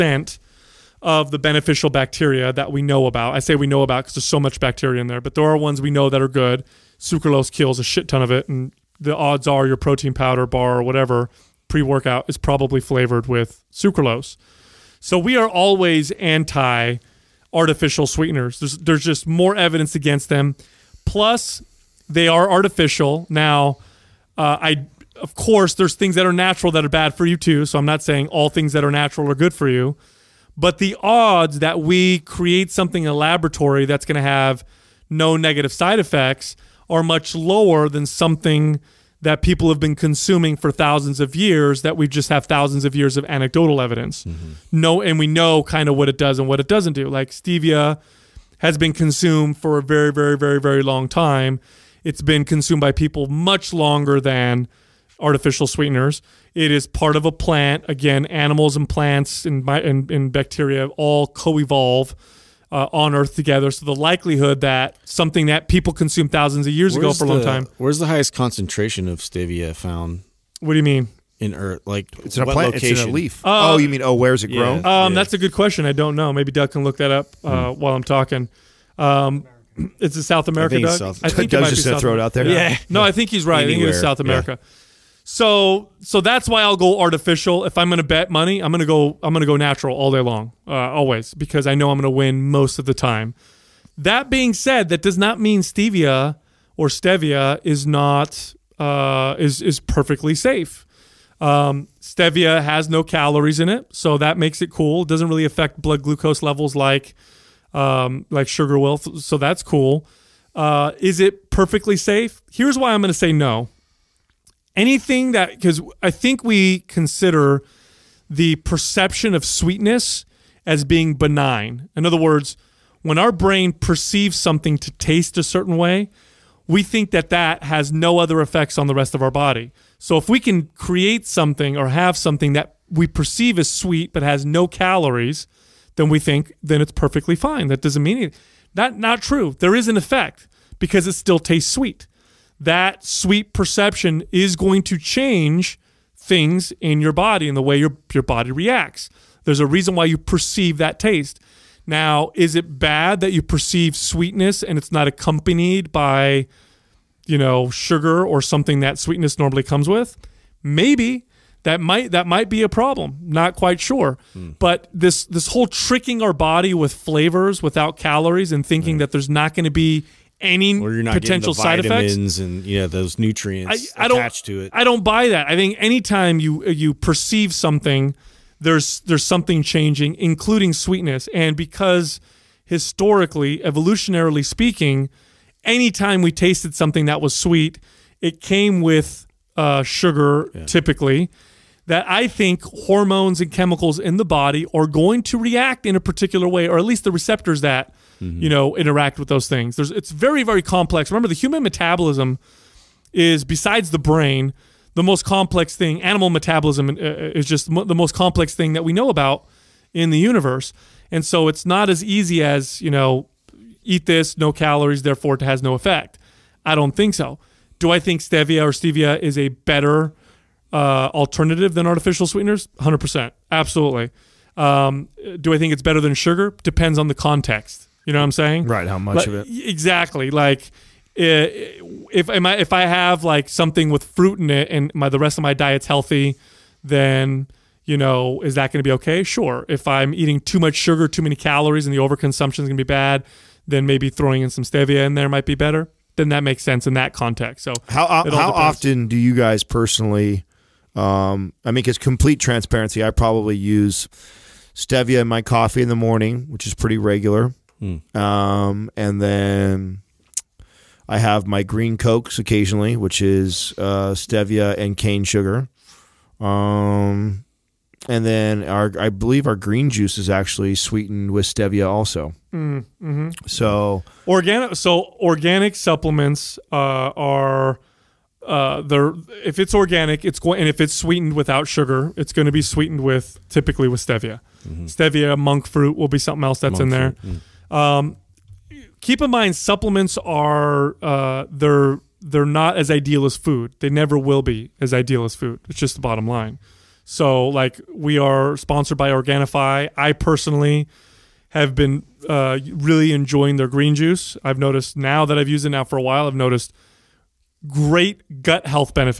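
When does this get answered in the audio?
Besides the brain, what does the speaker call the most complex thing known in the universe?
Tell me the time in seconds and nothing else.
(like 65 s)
206 s.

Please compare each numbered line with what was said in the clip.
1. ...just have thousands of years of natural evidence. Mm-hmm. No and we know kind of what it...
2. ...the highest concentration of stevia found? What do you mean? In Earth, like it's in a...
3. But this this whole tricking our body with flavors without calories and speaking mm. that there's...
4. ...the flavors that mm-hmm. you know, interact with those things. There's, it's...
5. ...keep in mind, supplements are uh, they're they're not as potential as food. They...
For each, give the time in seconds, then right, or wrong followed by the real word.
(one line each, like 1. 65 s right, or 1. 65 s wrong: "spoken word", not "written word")
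1. 42 s wrong: "anecdotal", not "natural"
2. 68 s right
3. 164 s wrong: "thinking", not "speaking"
4. 197 s wrong: "receptors", not "flavors"
5. 289 s wrong: "ideal", not "potential".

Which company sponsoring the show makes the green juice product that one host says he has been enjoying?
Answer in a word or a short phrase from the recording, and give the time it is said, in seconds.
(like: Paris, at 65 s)
Organifi, at 299 s.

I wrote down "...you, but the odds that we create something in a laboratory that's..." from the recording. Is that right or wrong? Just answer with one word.
right.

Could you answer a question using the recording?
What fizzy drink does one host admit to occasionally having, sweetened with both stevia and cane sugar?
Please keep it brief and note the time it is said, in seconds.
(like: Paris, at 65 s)
Green cokes, at 261 s.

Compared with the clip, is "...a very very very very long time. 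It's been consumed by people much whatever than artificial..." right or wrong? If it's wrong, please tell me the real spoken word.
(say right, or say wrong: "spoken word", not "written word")
wrong: "longer", not "whatever".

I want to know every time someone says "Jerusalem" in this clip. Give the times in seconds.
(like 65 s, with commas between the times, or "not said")
not said.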